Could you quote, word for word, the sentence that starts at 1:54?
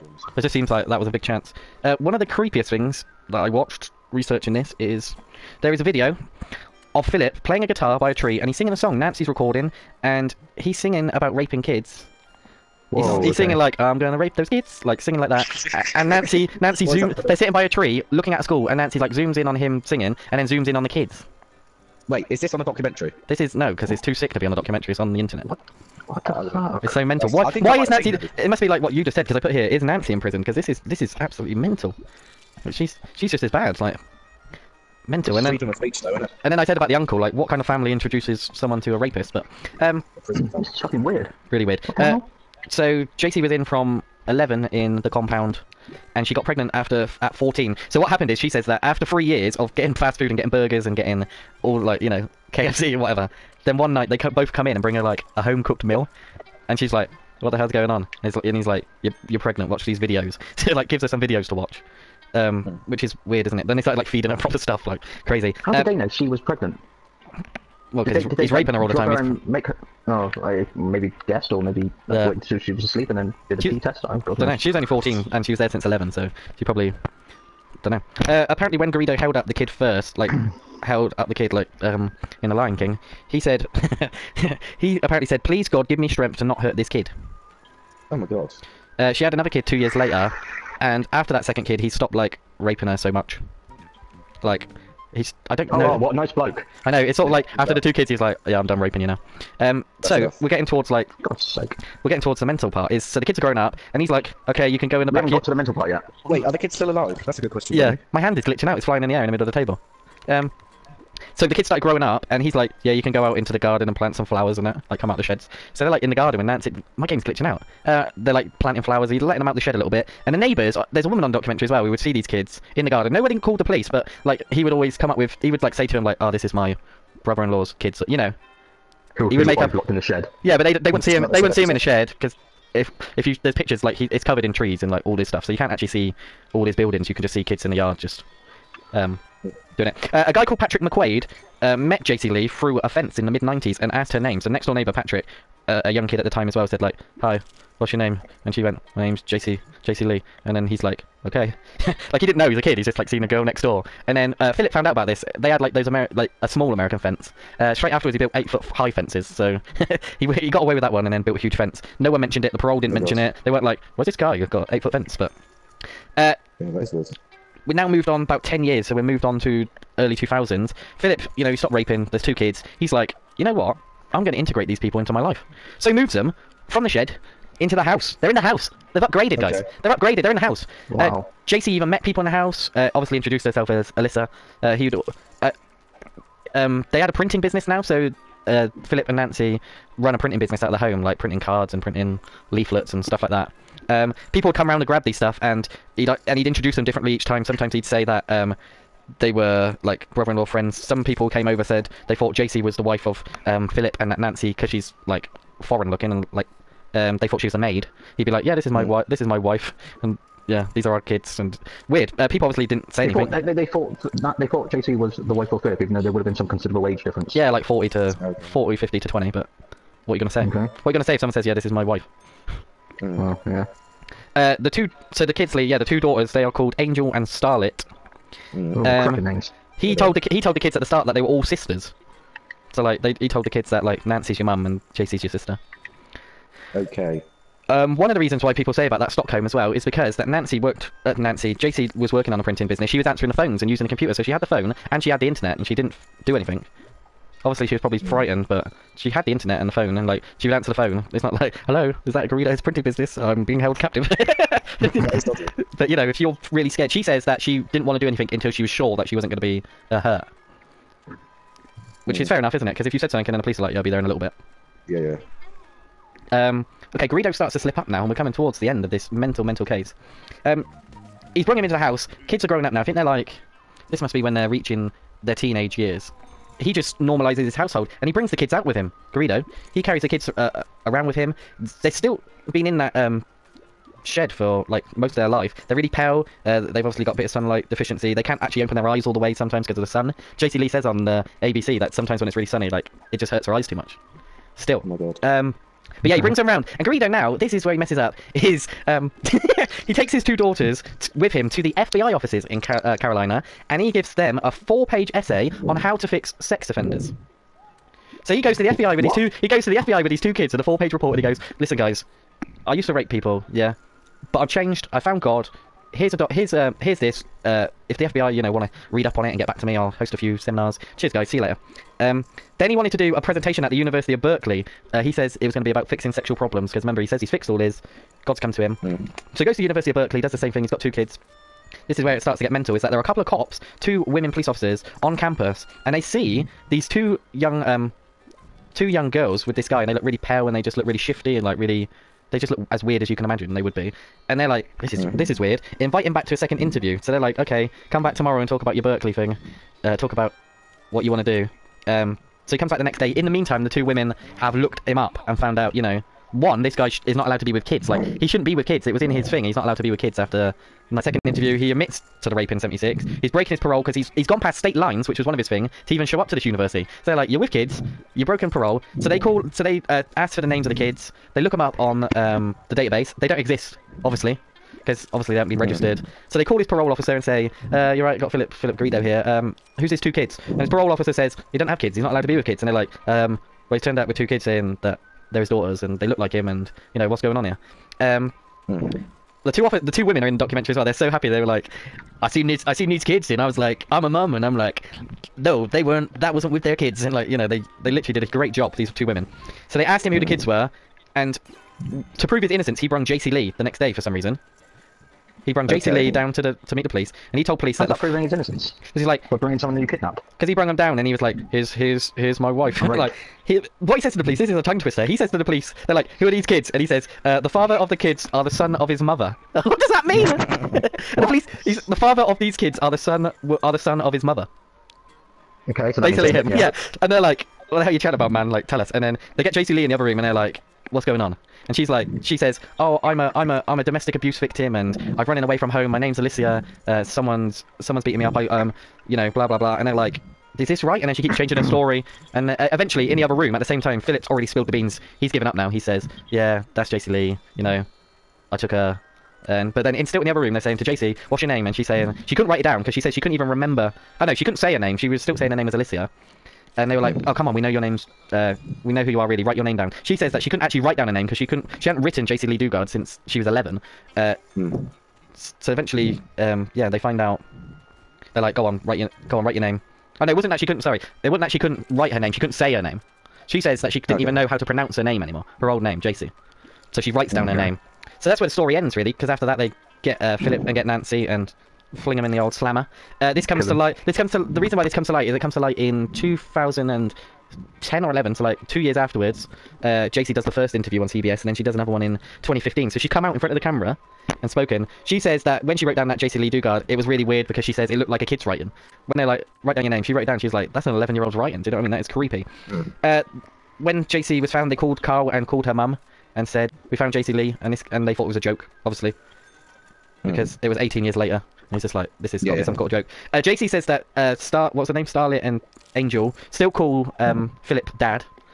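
Like, come out the sheds." So they're like in the garden when Nancy.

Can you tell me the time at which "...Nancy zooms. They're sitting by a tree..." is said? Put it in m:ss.
0:16.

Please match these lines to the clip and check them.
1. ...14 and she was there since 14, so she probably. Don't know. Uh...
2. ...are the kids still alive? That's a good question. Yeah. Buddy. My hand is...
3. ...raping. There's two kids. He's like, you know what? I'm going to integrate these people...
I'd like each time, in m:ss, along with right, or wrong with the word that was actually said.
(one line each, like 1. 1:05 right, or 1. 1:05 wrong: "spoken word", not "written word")
1. 1:14 wrong: "11", not "14"
2. 1:46 right
3. 2:51 right.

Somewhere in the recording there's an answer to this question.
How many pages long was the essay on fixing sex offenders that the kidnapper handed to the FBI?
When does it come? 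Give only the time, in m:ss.
5:04.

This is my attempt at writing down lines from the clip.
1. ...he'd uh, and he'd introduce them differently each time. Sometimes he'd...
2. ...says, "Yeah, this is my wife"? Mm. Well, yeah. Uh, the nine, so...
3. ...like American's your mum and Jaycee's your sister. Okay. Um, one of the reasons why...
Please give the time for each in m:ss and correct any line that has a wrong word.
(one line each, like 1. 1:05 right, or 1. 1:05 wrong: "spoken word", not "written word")
1. 3:15 right
2. 3:41 wrong: "two", not "nine"
3. 3:53 wrong: "Nancy", not "American".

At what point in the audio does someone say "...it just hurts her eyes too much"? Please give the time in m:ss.
4:53.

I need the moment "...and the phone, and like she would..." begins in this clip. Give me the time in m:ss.
4:09.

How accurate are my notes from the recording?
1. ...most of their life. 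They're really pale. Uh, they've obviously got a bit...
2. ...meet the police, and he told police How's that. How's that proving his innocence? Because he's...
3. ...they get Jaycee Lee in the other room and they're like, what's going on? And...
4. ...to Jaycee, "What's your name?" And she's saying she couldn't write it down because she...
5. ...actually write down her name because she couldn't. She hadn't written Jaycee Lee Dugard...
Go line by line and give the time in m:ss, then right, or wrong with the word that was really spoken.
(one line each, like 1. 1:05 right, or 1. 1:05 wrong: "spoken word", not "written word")
1. 4:44 right
2. 6:46 right
3. 7:09 right
4. 7:30 right
5. 7:40 right.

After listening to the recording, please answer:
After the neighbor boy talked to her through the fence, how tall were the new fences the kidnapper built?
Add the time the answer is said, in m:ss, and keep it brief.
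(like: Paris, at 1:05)
8 feet, at 2:38.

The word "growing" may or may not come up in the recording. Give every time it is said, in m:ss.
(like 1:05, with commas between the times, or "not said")
1:43, 1:51, 4:32.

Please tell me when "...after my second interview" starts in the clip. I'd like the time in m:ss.
6:00.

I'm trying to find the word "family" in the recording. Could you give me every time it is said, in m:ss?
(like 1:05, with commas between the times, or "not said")
0:37.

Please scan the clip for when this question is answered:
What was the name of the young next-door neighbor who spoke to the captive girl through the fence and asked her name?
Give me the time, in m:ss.
2:20.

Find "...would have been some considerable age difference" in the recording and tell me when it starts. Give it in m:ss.
3:36.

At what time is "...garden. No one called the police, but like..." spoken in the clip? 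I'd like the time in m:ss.
2:02.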